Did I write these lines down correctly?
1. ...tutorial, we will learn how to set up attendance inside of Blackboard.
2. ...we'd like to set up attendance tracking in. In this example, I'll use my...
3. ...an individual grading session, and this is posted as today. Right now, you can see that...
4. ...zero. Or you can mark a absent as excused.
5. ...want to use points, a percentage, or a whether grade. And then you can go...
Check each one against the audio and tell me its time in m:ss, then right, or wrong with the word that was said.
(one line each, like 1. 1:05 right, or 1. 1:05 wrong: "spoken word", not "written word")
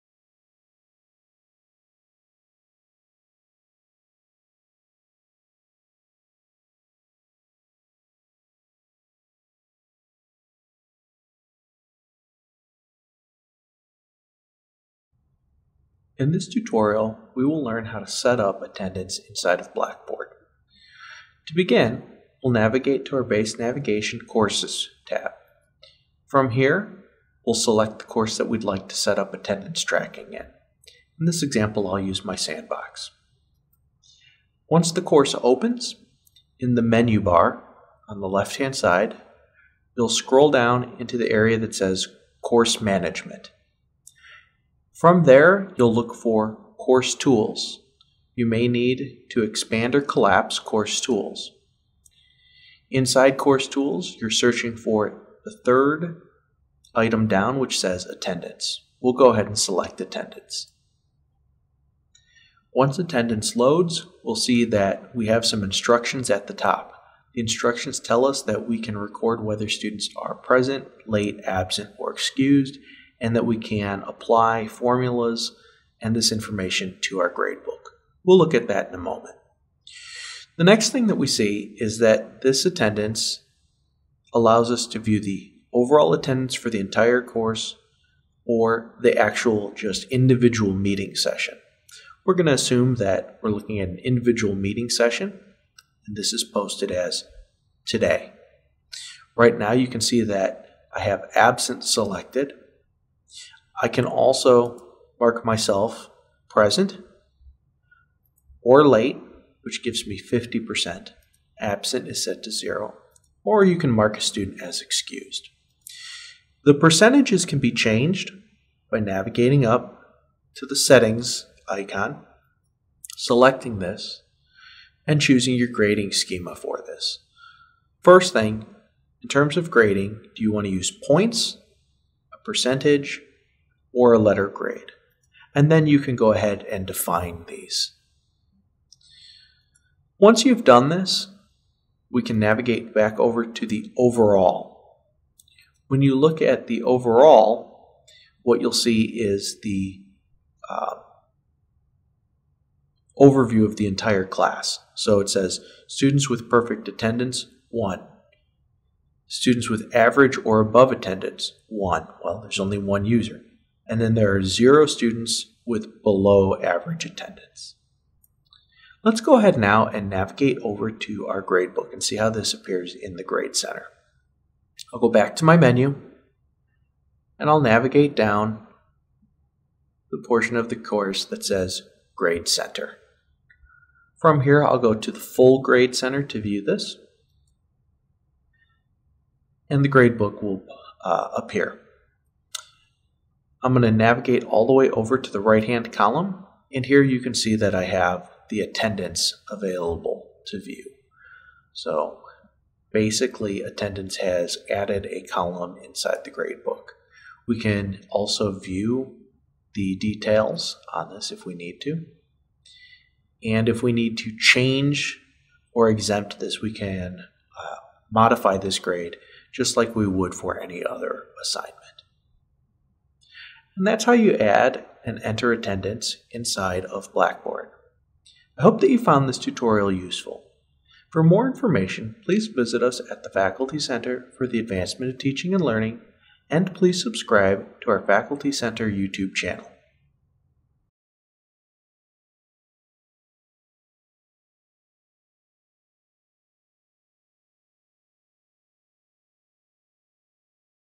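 1. 0:16 right
2. 0:28 right
3. 1:33 wrong: "meeting", not "grading"
4. 1:52 wrong: "student", not "absent"
5. 2:10 wrong: "letter", not "whether".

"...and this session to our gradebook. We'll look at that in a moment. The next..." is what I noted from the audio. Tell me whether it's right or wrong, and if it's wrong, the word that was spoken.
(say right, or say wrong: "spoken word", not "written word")
wrong: "information", not "session".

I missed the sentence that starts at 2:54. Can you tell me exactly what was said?
I'll go back to my menu and I'll navigate down the portion of the course that says Grade Center.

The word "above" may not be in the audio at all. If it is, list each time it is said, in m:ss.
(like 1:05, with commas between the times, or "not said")
2:40.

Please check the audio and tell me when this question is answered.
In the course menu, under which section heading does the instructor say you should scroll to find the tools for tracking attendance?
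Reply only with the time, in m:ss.
0:42.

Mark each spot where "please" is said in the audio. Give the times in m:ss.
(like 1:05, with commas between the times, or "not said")
3:52, 3:56.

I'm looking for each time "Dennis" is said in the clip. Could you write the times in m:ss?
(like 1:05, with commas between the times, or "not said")
not said.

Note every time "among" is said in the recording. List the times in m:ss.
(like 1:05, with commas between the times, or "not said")
not said.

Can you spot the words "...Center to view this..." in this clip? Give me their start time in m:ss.
3:05.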